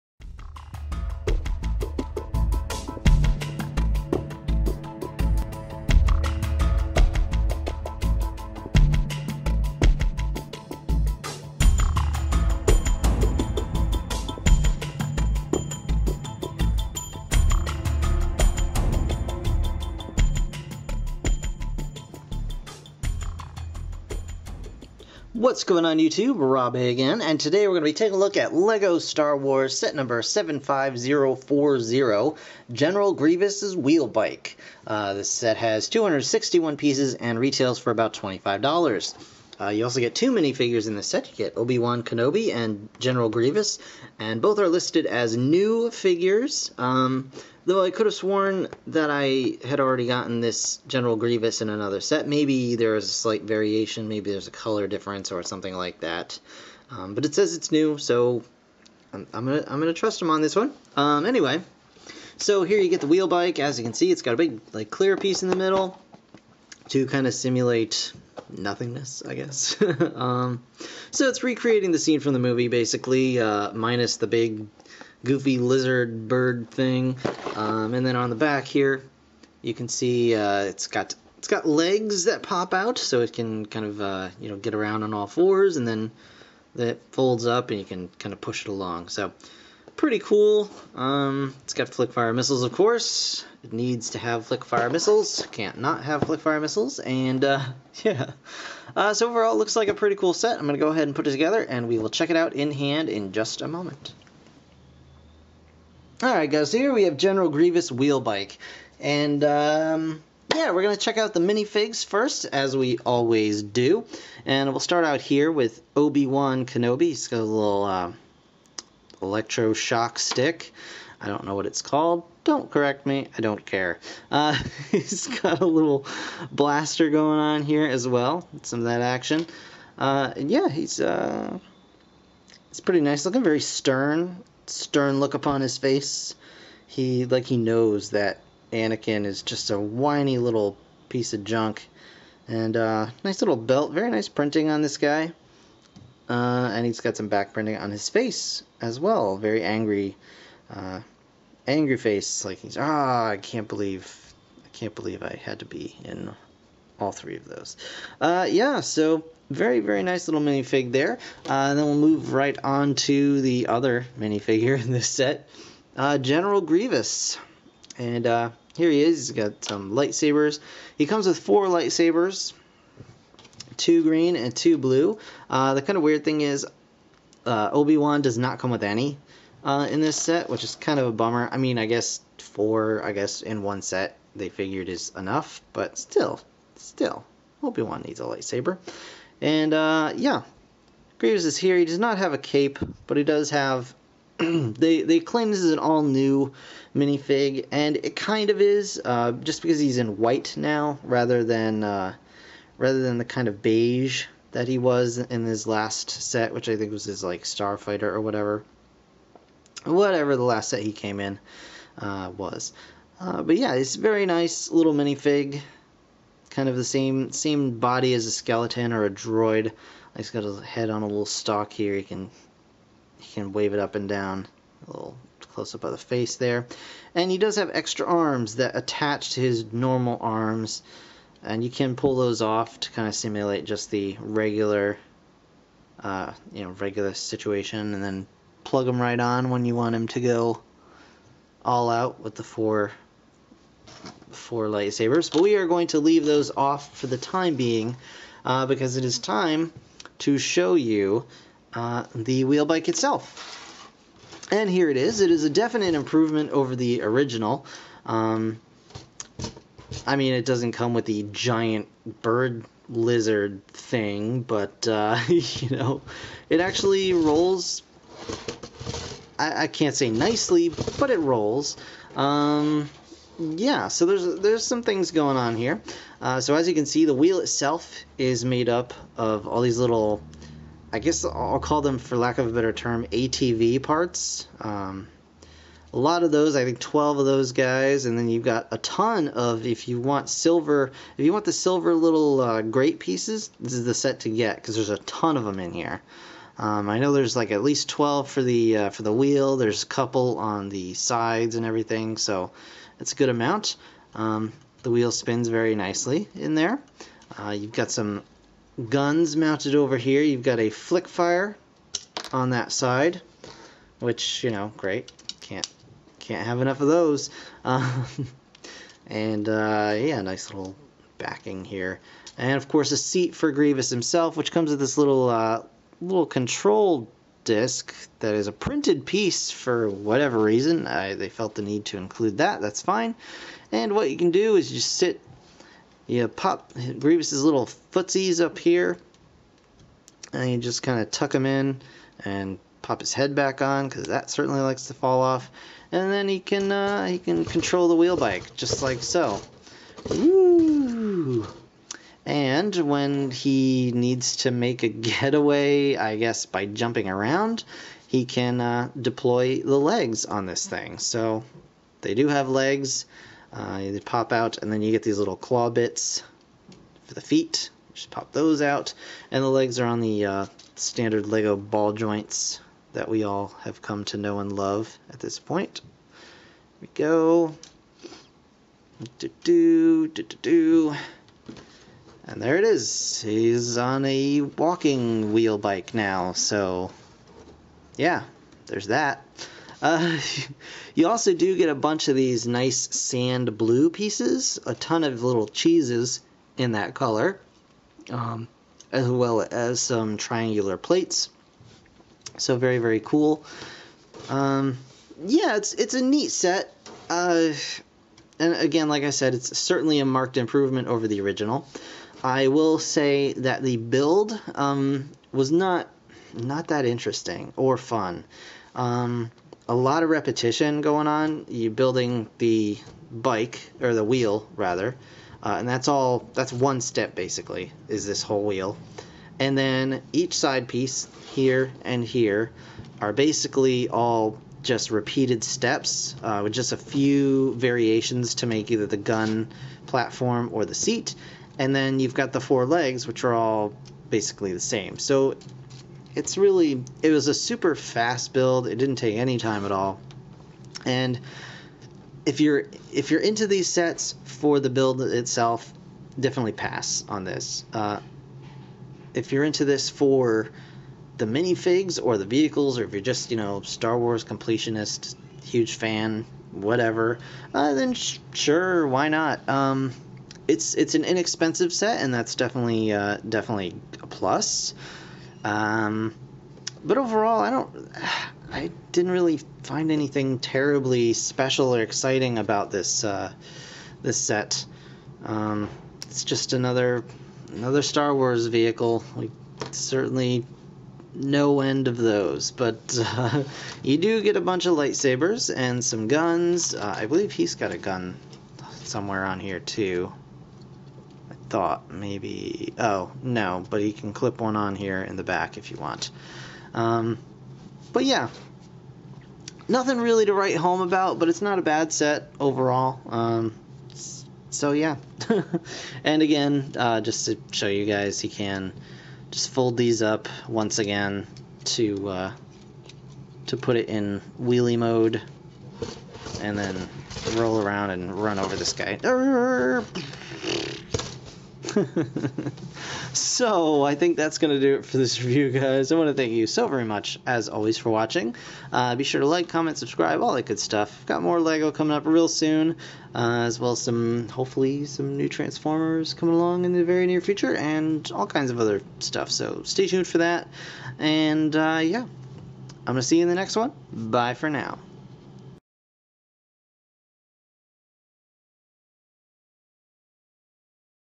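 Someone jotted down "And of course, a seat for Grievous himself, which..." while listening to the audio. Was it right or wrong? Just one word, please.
right.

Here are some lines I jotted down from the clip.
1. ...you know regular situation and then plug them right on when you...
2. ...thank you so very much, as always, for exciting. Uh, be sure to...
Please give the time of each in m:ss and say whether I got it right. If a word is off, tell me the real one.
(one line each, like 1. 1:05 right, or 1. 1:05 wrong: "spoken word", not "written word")
1. 3:56 right
2. 8:56 wrong: "watching", not "exciting".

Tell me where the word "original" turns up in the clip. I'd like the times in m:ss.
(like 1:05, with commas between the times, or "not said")
4:17, 6:51.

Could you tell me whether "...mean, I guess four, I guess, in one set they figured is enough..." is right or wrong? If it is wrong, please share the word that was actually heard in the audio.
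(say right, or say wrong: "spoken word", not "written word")
right.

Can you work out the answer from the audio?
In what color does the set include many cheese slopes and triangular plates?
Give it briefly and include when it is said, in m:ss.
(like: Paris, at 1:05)
sand blue, at 6:32.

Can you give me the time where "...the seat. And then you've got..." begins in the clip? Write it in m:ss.
7:20.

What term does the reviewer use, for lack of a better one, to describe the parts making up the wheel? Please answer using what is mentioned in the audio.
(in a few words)
ATV parts.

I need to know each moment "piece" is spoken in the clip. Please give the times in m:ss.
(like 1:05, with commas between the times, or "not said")
0:36, 1:05, 2:21, 4:52, 5:29, 6:33, 7:10.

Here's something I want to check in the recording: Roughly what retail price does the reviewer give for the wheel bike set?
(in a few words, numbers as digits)
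$25.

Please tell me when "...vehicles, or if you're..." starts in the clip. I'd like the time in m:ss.
7:42.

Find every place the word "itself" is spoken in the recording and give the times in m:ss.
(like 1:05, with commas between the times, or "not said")
4:12, 4:37, 7:35.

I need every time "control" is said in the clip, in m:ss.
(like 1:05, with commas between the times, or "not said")
5:26, 5:47.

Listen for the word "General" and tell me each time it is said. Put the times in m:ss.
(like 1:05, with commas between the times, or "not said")
0:32, 0:42, 0:50, 1:47, 2:46.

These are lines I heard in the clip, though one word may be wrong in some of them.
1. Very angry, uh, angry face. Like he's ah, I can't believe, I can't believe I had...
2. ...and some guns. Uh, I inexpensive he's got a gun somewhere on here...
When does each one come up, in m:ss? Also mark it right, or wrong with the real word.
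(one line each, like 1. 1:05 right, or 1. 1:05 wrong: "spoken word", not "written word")
1. 2:29 right
2. 8:15 wrong: "believe", not "inexpensive".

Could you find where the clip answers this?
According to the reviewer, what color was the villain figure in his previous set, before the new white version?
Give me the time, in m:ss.
3:23.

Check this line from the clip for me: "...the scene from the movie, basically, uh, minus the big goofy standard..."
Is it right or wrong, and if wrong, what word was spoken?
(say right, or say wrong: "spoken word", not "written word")
wrong: "lizard", not "standard".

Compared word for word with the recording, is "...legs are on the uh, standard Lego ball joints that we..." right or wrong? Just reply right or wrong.
right.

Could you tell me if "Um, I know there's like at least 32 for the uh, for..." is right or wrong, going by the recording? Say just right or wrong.
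wrong.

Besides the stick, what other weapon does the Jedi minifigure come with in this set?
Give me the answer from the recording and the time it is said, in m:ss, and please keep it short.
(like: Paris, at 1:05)
blaster, at 2:06.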